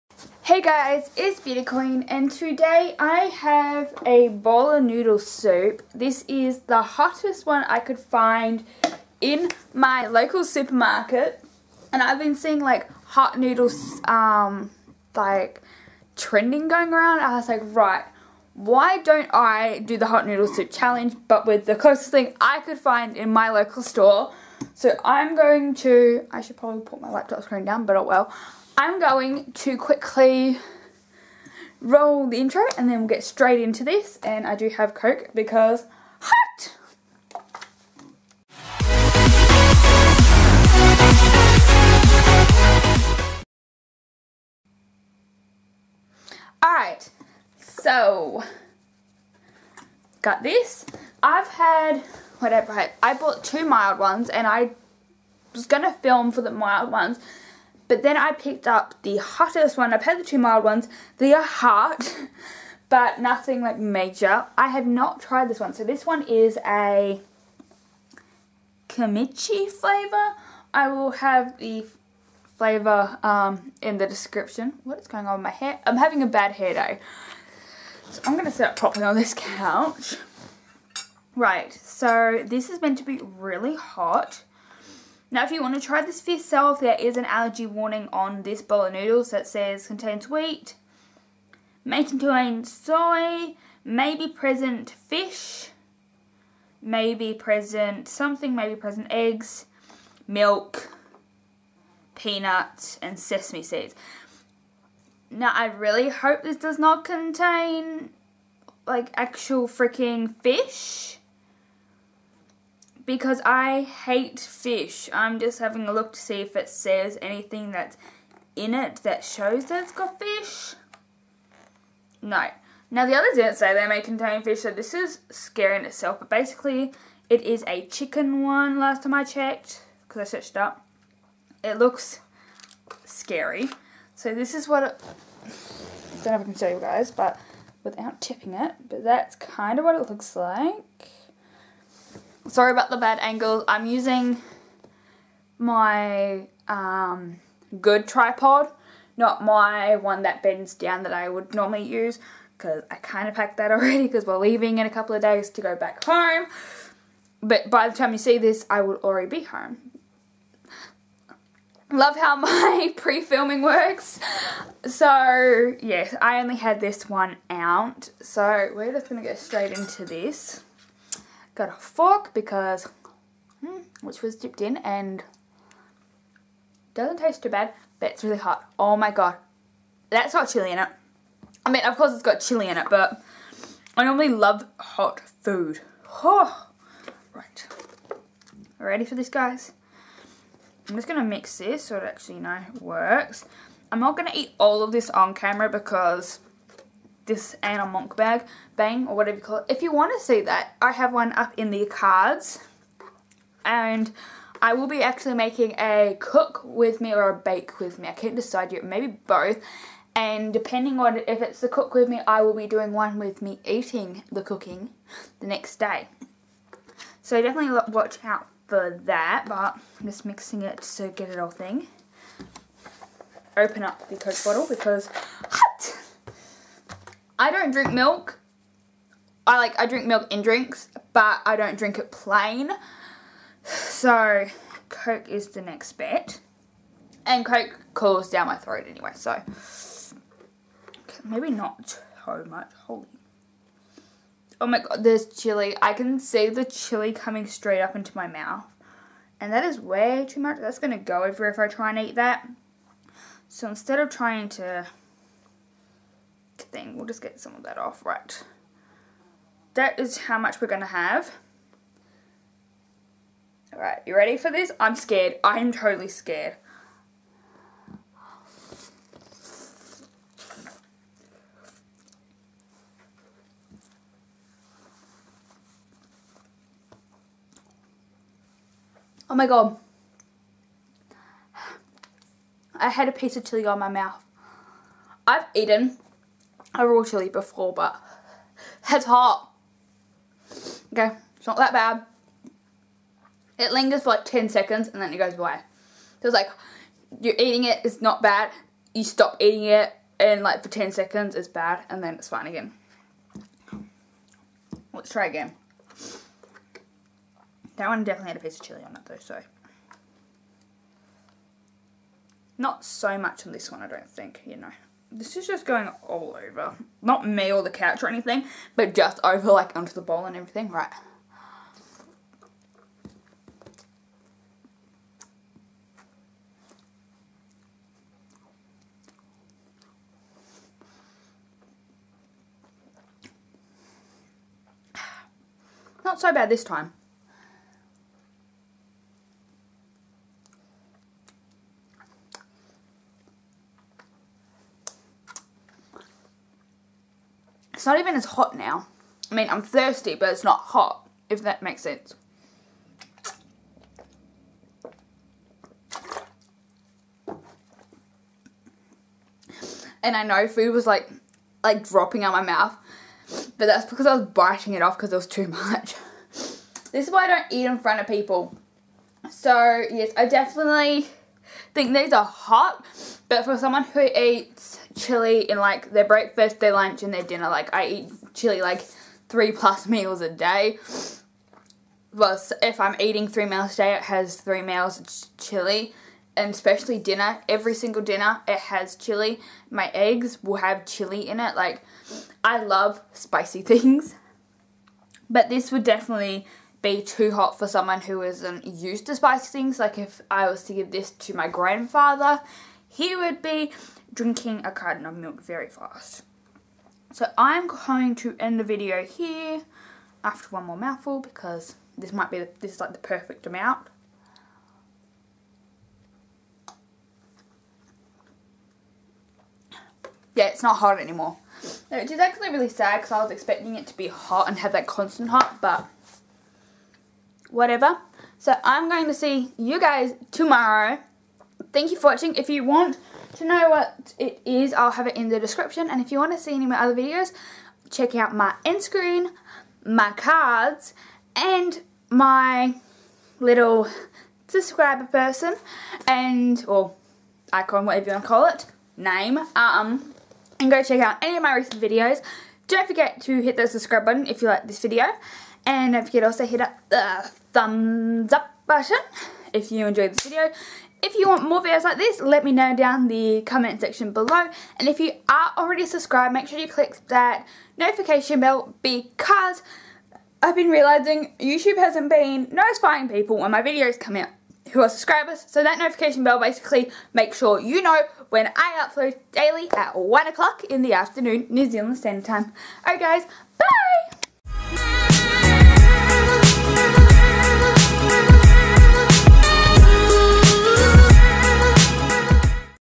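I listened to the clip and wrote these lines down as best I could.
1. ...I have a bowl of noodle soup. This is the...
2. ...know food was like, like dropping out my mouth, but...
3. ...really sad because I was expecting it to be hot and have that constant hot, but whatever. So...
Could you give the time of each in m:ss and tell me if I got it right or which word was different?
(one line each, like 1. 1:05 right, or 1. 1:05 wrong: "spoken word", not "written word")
1. 0:02 right
2. 6:00 right
3. 7:02 right.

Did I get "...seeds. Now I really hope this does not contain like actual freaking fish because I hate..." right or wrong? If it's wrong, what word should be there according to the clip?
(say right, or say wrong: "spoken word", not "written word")
right.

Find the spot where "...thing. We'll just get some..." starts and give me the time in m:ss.
4:16.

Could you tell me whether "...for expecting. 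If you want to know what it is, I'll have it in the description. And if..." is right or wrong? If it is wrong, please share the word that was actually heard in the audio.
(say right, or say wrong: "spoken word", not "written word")
wrong: "watching", not "expecting".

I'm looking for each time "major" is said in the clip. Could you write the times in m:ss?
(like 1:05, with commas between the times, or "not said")
1:03.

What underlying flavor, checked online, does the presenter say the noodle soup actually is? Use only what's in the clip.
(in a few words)
Chicken.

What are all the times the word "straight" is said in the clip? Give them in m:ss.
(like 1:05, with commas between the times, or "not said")
0:33, 2:49, 4:07.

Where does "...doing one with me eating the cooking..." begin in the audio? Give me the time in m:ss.
3:32.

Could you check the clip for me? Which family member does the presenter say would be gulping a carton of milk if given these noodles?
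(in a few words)
Grandfather.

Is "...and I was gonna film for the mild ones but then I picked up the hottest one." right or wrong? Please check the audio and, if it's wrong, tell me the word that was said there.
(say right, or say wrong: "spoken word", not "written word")
right.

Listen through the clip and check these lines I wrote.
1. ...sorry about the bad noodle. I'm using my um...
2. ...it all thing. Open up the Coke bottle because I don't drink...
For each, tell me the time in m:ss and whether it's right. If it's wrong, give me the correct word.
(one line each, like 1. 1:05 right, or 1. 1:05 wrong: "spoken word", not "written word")
1. 2:22 wrong: "angle", not "noodle"
2. 3:41 right.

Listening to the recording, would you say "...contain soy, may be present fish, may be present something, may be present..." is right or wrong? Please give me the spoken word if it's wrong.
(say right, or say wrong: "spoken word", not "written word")
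right.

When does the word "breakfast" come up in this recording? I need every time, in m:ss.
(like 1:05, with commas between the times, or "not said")
6:16.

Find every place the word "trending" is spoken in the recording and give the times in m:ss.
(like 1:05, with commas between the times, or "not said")
0:16.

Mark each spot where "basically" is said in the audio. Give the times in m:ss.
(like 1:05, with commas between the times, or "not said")
2:06, 7:56.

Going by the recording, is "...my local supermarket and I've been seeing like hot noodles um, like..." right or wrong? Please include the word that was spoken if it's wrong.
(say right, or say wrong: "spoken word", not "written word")
right.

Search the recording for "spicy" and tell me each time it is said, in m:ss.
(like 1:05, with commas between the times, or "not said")
6:33, 6:39.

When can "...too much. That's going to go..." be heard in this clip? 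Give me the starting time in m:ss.
4:10.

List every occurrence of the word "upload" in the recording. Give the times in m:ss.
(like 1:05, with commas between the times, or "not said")
7:58.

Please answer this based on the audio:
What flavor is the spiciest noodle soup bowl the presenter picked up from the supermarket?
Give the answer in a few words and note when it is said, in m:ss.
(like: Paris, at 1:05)
Kimchi, at 1:08.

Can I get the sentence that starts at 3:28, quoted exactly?
I can't decide yet, maybe both.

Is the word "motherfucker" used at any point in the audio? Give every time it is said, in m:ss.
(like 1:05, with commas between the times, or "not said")
not said.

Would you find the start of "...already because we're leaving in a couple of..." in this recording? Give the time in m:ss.
2:33.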